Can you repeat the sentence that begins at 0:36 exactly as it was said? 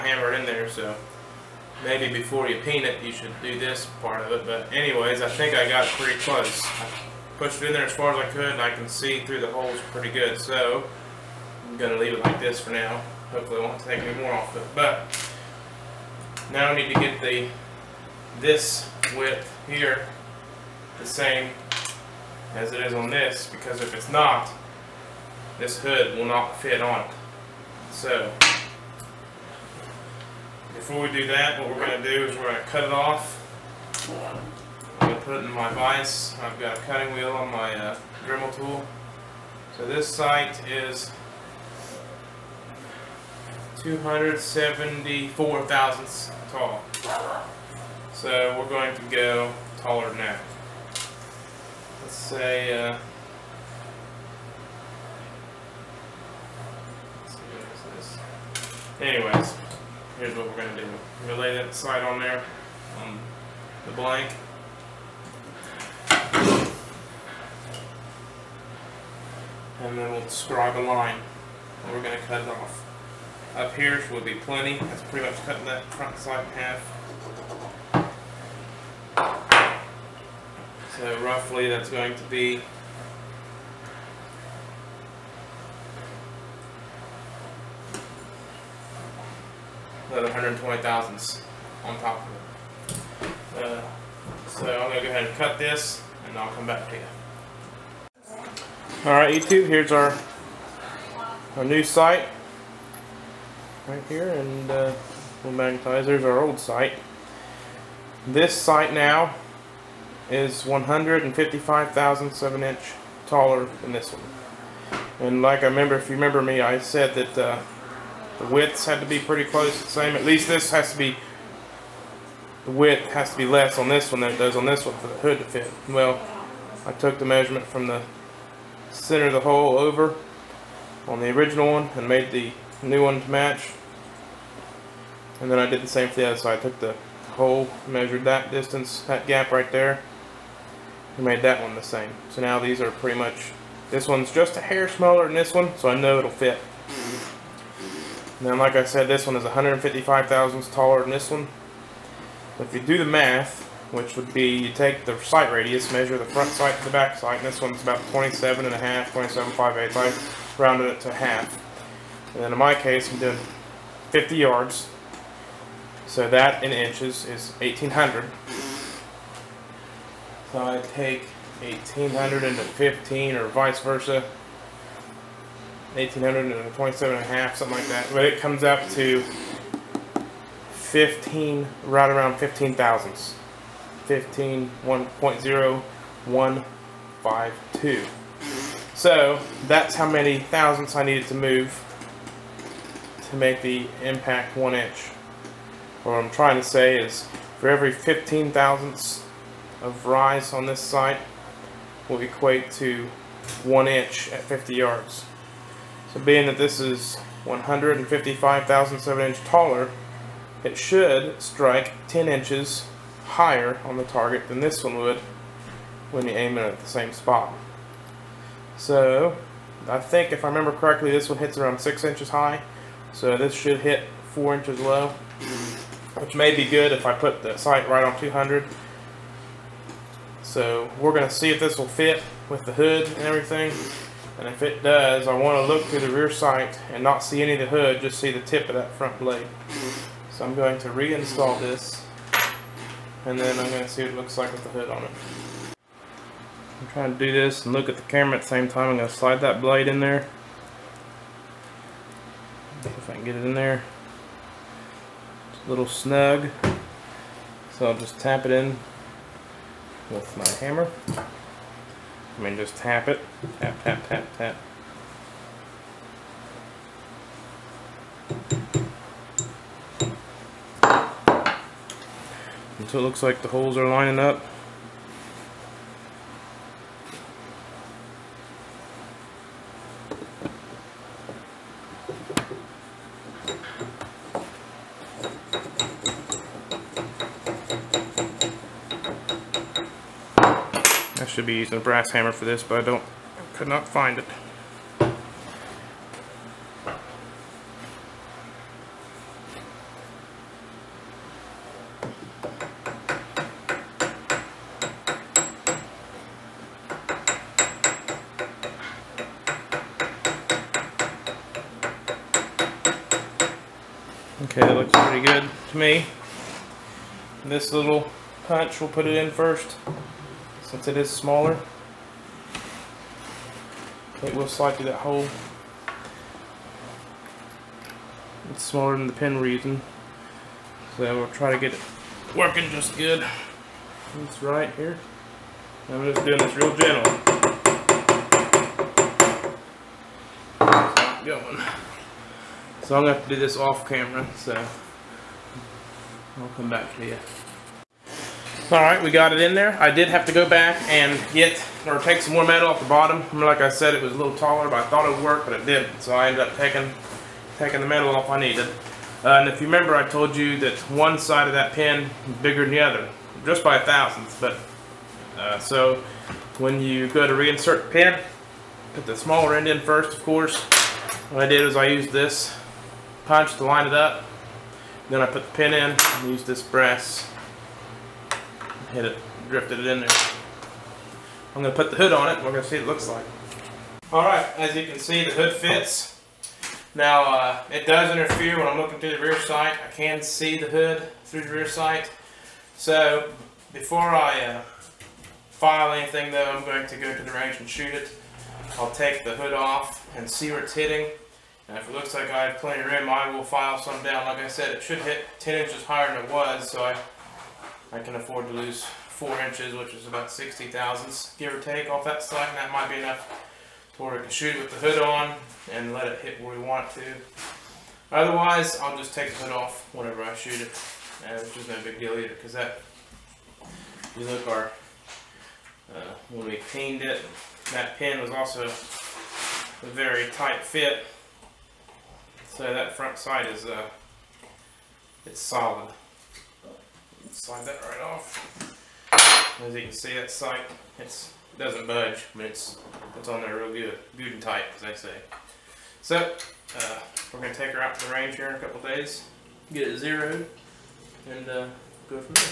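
I've got a cutting wheel on my uh, Dremel tool.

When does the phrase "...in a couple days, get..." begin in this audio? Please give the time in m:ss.
7:28.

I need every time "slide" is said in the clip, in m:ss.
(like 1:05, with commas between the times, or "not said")
1:01, 4:09, 5:24, 7:17.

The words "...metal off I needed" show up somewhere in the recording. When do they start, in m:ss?
5:57.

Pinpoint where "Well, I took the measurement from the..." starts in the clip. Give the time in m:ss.
2:05.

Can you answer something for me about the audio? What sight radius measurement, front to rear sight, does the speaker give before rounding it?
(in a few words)
27.58.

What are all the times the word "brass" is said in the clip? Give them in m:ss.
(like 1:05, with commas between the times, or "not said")
4:51, 6:16.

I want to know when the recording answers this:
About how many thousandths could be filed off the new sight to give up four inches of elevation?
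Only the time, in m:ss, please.
6:50.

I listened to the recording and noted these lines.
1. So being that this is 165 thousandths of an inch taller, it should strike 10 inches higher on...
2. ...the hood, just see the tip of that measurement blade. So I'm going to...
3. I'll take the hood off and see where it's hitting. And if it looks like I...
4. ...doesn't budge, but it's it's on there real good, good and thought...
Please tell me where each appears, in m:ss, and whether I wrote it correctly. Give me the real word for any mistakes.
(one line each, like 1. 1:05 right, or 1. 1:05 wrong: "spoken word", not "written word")
1. 3:26 wrong: "155", not "165"
2. 3:57 wrong: "front", not "measurement"
3. 6:38 right
4. 7:21 wrong: "tight", not "thought".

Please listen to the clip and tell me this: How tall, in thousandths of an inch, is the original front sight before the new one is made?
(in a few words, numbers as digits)
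274 thousandths.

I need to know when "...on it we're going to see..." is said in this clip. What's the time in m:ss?
6:22.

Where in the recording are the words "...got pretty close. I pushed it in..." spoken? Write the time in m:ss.
0:05.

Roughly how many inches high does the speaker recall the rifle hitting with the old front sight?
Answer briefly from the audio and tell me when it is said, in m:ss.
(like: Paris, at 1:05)
6 inches, at 3:41.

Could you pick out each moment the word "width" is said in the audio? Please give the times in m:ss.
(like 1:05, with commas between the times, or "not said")
0:19, 1:58, 2:02.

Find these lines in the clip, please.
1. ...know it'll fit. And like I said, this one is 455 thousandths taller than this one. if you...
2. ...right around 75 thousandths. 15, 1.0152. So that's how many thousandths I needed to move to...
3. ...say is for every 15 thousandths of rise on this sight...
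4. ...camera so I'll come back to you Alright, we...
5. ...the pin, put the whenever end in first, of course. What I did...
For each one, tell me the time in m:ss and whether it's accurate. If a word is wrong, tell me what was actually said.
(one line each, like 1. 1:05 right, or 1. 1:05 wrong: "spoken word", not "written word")
1. 2:25 wrong: "155", not "455"
2. 3:01 wrong: "15", not "75"
3. 3:16 right
4. 5:43 right
5. 6:07 wrong: "smaller", not "whenever".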